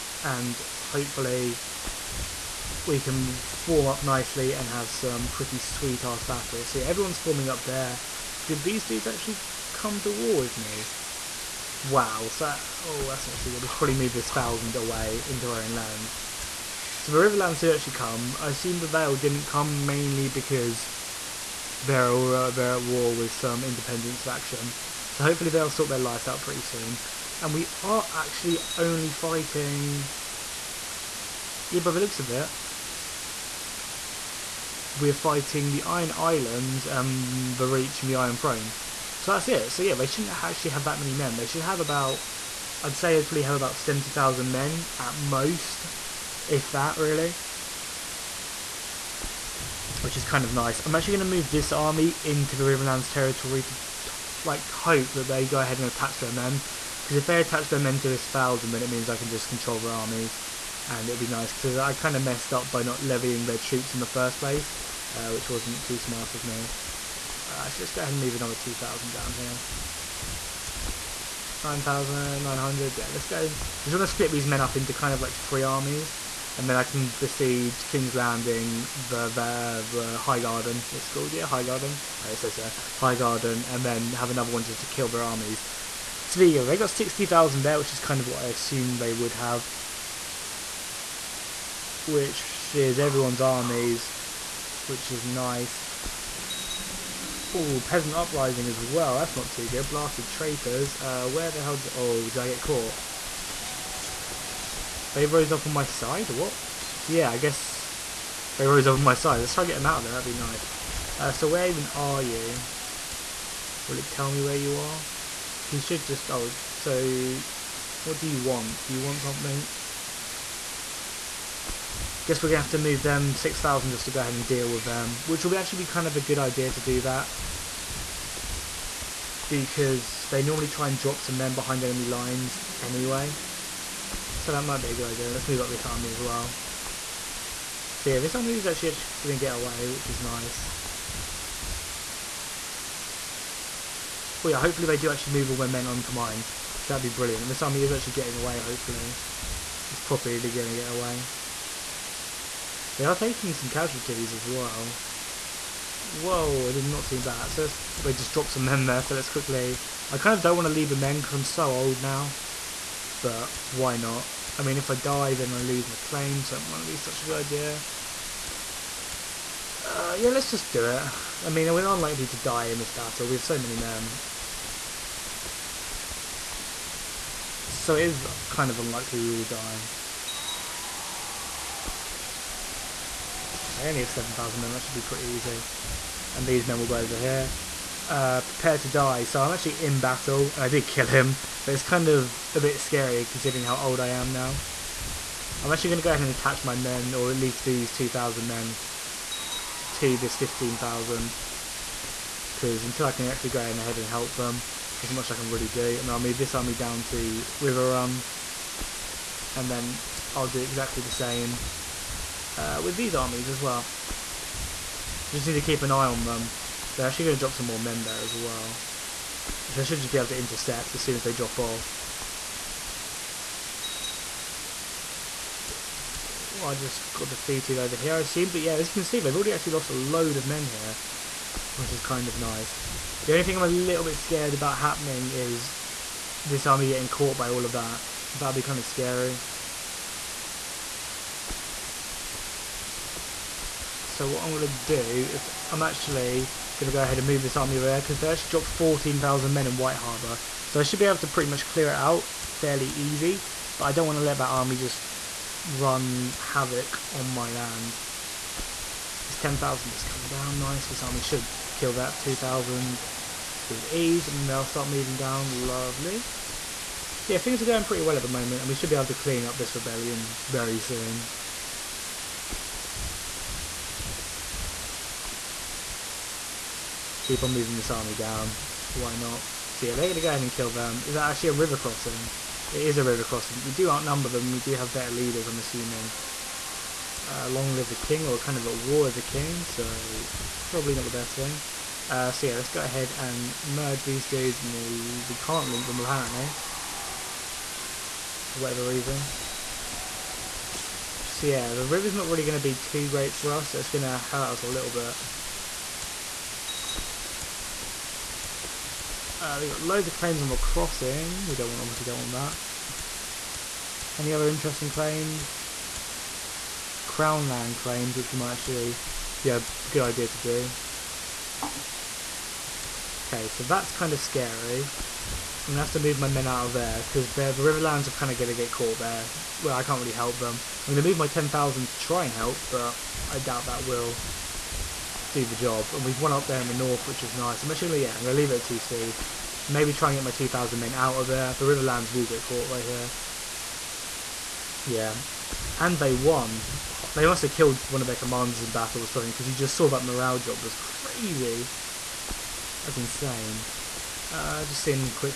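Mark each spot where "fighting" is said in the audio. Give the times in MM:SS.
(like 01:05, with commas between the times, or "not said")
00:29, 00:35.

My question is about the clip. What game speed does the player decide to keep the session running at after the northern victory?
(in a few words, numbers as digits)
2.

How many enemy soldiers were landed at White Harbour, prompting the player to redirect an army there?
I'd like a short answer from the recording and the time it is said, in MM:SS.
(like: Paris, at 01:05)
14,000, at 04:08.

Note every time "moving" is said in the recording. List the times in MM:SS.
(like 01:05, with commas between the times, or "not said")
04:24, 04:37.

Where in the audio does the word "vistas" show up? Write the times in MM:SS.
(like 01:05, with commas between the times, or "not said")
not said.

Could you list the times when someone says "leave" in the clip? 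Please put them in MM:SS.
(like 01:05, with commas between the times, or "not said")
02:40, 05:38.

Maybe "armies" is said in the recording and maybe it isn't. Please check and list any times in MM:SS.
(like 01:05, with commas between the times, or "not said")
00:59, 01:15, 01:25, 01:33, 03:33.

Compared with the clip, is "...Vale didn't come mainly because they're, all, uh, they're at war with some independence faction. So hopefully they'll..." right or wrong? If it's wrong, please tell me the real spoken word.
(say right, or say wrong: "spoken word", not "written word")
right.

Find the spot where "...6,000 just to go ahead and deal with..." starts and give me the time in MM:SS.
02:03.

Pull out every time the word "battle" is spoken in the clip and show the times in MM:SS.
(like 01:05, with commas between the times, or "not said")
00:06, 02:52, 03:09, 05:48.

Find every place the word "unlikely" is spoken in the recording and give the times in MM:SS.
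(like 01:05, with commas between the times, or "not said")
02:51, 02:58.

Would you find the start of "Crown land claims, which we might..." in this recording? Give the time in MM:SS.
05:17.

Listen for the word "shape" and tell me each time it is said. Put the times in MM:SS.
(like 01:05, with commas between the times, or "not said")
not said.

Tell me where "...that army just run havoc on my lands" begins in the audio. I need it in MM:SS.
04:14.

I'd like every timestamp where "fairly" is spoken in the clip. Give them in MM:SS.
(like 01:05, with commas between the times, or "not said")
04:12.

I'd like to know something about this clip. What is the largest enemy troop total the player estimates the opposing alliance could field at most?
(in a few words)
70,000.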